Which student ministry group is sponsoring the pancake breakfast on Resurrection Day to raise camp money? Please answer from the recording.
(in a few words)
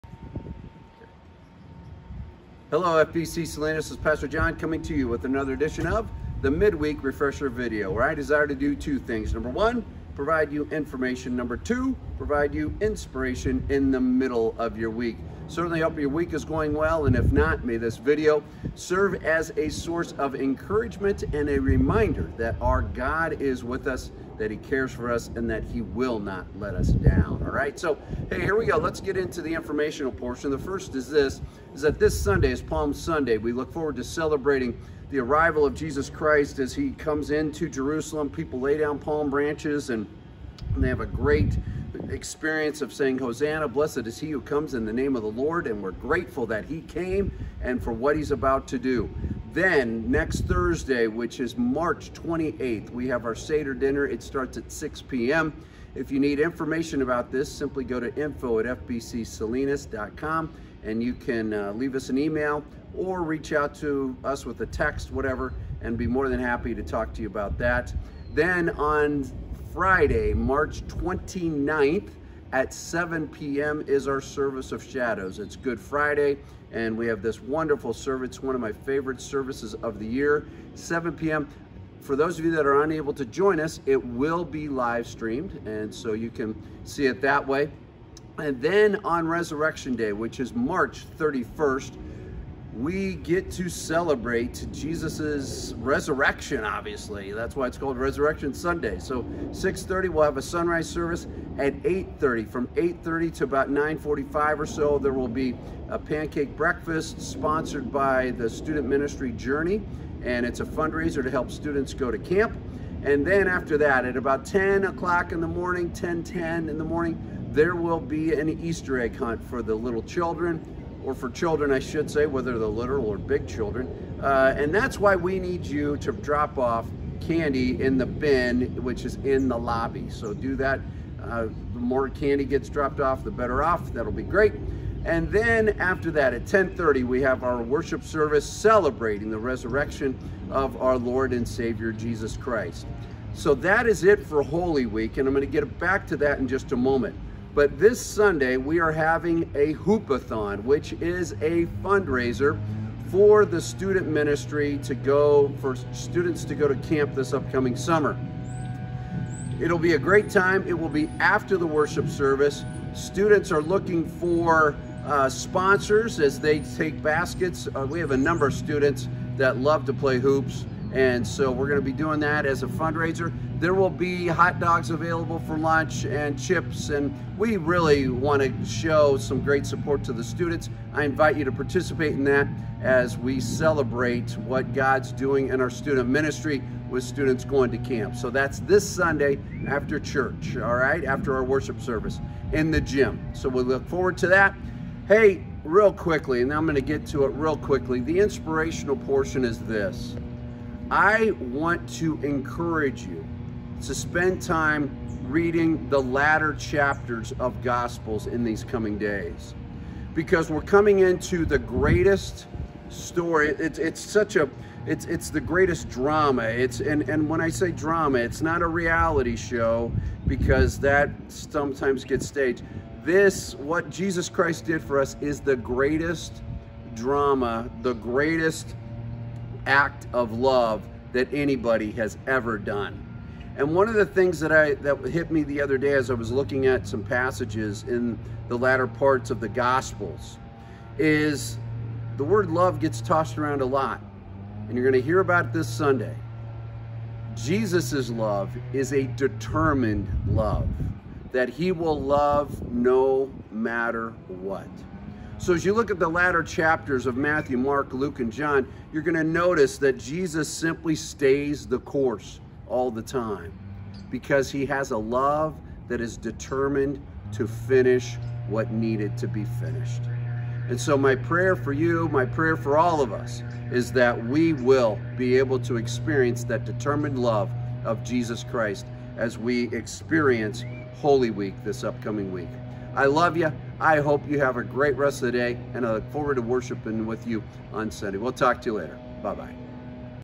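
Journey.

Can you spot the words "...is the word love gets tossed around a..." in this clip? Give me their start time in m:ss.
4:00.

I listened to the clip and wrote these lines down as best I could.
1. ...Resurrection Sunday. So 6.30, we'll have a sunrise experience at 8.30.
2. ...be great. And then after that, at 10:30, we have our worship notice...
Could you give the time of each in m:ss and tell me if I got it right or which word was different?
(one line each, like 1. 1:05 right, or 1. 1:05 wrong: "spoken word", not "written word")
1. 1:37 wrong: "service", not "experience"
2. 2:14 wrong: "service", not "notice".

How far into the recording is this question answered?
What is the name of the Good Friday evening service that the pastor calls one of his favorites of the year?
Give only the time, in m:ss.
1:14.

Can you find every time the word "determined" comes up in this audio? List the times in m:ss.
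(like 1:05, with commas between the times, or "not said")
4:09, 4:26, 4:36.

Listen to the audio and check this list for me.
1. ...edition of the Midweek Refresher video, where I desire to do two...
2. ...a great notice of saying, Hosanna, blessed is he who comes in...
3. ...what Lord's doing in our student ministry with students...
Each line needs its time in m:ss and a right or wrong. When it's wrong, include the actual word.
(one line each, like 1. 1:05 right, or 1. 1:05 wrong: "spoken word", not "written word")
1. 0:05 right
2. 0:41 wrong: "experience", not "notice"
3. 3:04 wrong: "God", not "Lord".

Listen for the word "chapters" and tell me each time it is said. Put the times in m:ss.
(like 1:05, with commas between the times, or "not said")
3:26, 4:16.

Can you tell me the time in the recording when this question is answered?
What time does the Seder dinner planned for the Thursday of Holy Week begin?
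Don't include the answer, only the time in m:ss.
0:54.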